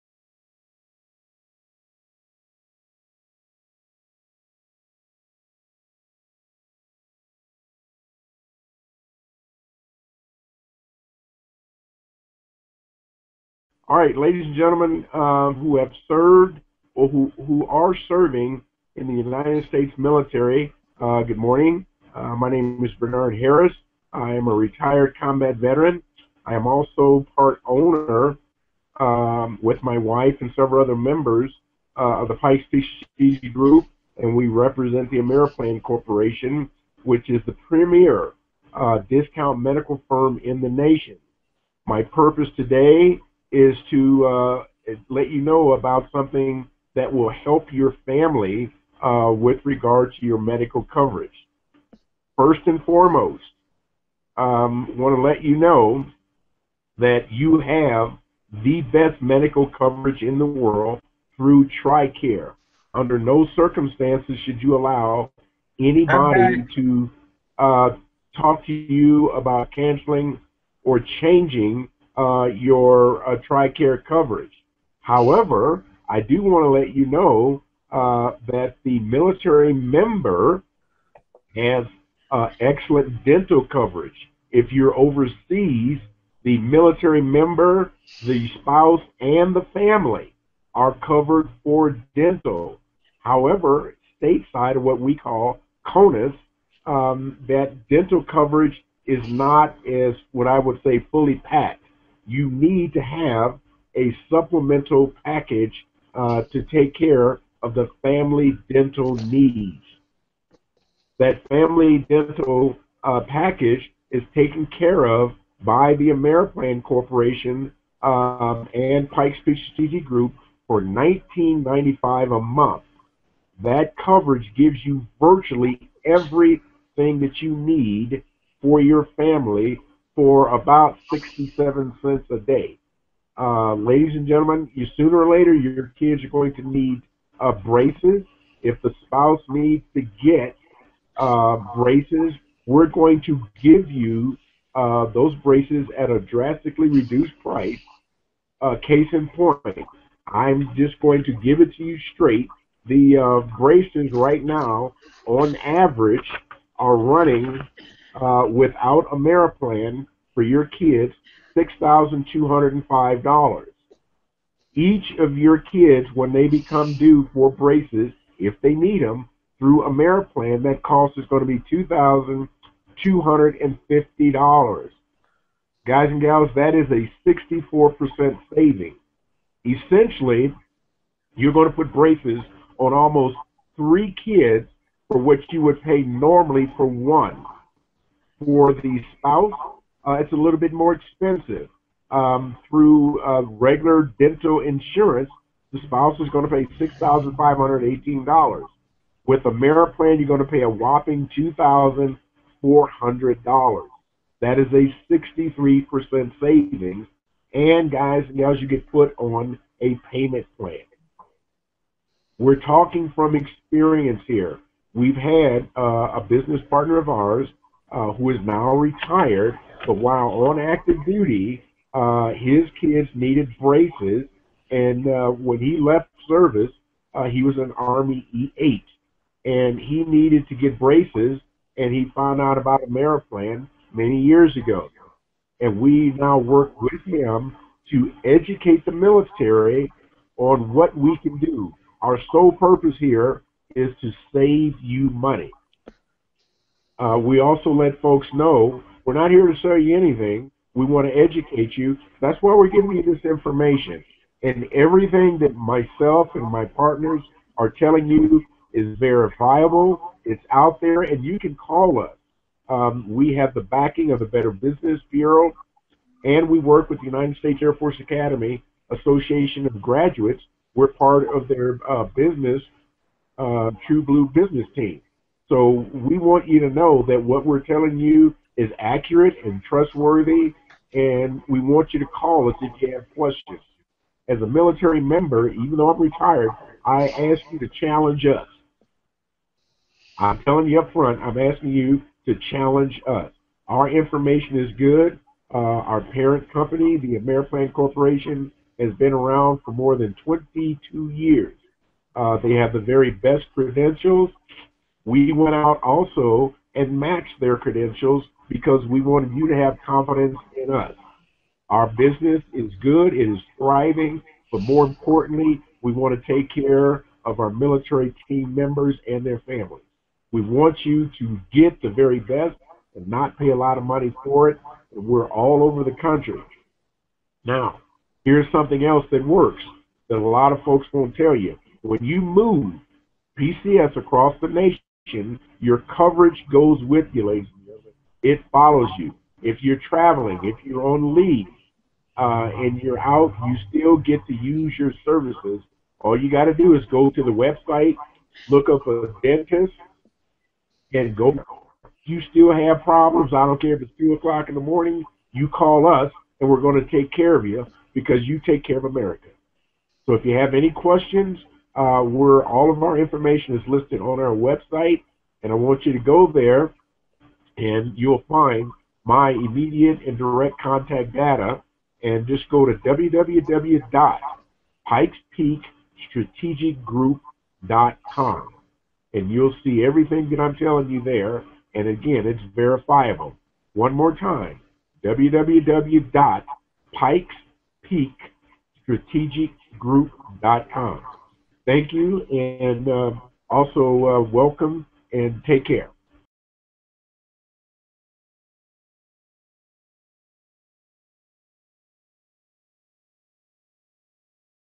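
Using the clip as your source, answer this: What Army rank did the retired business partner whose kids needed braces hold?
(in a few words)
E8.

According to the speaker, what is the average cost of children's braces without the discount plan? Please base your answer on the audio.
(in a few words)
$6,205.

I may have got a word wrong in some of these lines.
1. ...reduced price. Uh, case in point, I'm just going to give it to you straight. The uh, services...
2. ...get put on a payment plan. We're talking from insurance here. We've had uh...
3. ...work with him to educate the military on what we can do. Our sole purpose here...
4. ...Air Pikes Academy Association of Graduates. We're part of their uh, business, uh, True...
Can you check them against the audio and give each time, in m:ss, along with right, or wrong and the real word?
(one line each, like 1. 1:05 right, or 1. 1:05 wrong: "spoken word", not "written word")
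1. 2:26 wrong: "braces", not "services"
2. 3:28 wrong: "experience", not "insurance"
3. 3:56 right
4. 4:27 wrong: "Force", not "Pikes".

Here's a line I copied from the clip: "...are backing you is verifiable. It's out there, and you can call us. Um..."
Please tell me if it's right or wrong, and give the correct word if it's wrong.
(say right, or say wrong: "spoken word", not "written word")
wrong: "telling", not "backing".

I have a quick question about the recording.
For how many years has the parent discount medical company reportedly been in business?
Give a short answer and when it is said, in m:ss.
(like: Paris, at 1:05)
More than 22 years, at 4:59.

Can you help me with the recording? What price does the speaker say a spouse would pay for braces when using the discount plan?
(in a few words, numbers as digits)
$2,400.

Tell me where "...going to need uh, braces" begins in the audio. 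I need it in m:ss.
2:16.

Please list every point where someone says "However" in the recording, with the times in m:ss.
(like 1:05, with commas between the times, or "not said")
1:14, 1:33.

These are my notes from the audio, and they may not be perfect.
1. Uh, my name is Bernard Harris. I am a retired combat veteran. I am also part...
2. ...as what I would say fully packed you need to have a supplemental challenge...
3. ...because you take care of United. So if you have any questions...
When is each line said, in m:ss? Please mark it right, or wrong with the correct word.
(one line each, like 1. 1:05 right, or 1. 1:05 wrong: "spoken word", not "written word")
1. 0:22 right
2. 1:39 wrong: "package", not "challenge"
3. 5:57 wrong: "America", not "United".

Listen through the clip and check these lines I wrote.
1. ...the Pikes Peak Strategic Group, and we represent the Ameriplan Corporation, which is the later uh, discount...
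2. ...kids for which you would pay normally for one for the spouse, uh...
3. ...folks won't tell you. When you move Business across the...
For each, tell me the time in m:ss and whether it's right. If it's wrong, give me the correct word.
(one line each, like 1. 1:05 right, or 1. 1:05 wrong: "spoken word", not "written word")
1. 0:32 wrong: "premier", not "later"
2. 3:04 right
3. 5:30 wrong: "PCS", not "Business".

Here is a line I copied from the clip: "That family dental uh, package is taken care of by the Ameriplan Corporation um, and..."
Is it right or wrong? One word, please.
right.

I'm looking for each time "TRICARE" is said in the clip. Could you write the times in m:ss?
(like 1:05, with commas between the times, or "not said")
1:01, 1:13.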